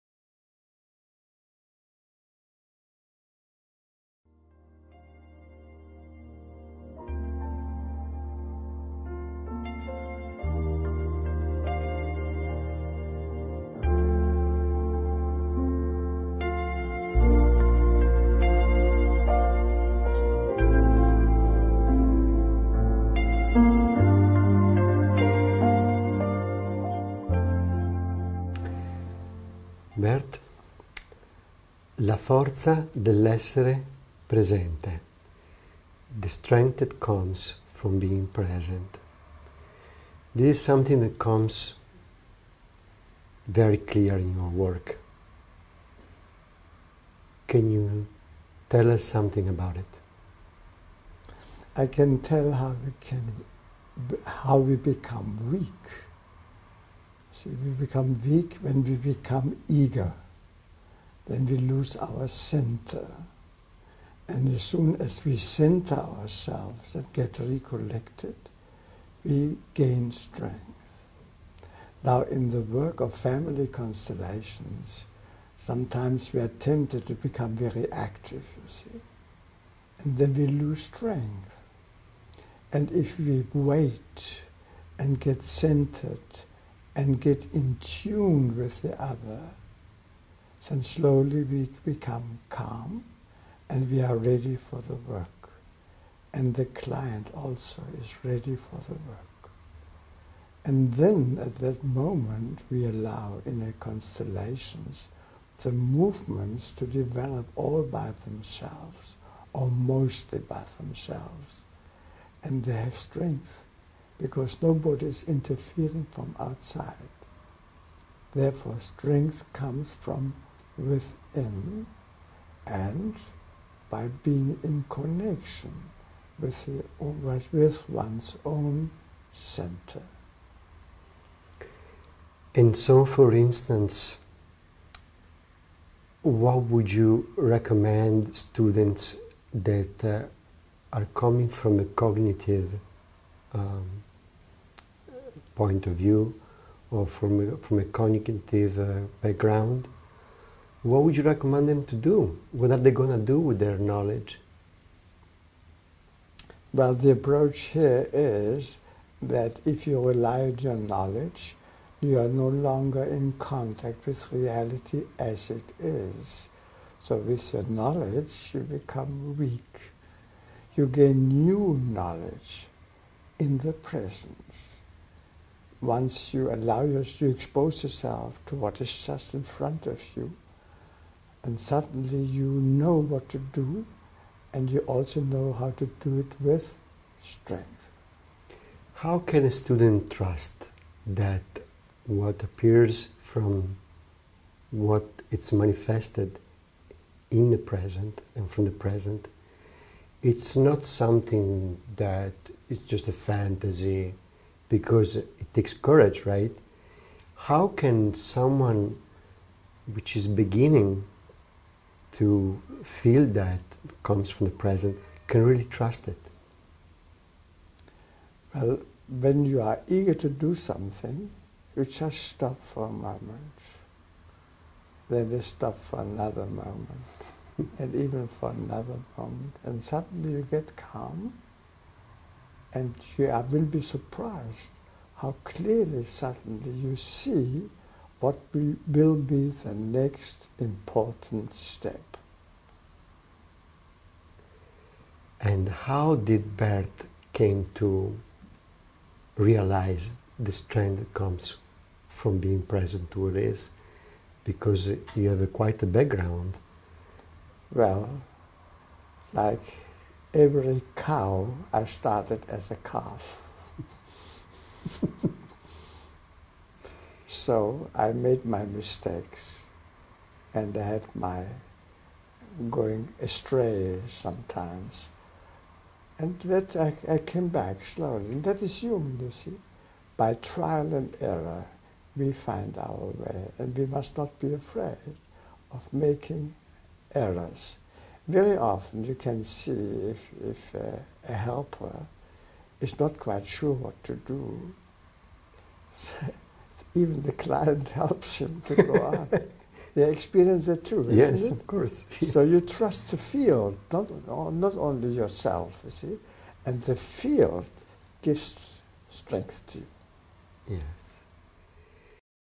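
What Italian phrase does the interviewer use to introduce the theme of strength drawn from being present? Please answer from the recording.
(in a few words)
la forza dell'essere presente.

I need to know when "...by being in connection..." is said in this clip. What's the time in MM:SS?
02:03.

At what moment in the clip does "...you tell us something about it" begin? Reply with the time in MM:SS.
00:47.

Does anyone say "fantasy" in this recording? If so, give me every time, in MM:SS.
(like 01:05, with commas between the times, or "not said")
03:23.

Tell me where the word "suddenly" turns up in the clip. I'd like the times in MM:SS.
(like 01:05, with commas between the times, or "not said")
03:01, 03:49, 03:56.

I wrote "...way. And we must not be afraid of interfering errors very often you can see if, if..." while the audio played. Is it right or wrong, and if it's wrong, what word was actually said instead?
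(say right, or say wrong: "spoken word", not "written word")
wrong: "making", not "interfering".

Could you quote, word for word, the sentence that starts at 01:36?
And the client also is ready for the work.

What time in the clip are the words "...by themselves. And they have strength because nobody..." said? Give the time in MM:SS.
01:50.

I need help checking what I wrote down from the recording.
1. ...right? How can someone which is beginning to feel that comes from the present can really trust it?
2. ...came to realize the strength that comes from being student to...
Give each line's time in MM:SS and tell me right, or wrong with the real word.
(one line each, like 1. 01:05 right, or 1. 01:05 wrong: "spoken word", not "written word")
1. 03:26 right
2. 04:07 wrong: "present", not "student".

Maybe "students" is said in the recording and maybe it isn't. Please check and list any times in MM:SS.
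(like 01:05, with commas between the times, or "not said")
02:18, 03:09.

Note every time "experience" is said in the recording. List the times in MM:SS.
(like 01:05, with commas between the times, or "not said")
05:00.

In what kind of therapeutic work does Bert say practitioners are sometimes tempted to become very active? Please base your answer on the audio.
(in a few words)
family constellations.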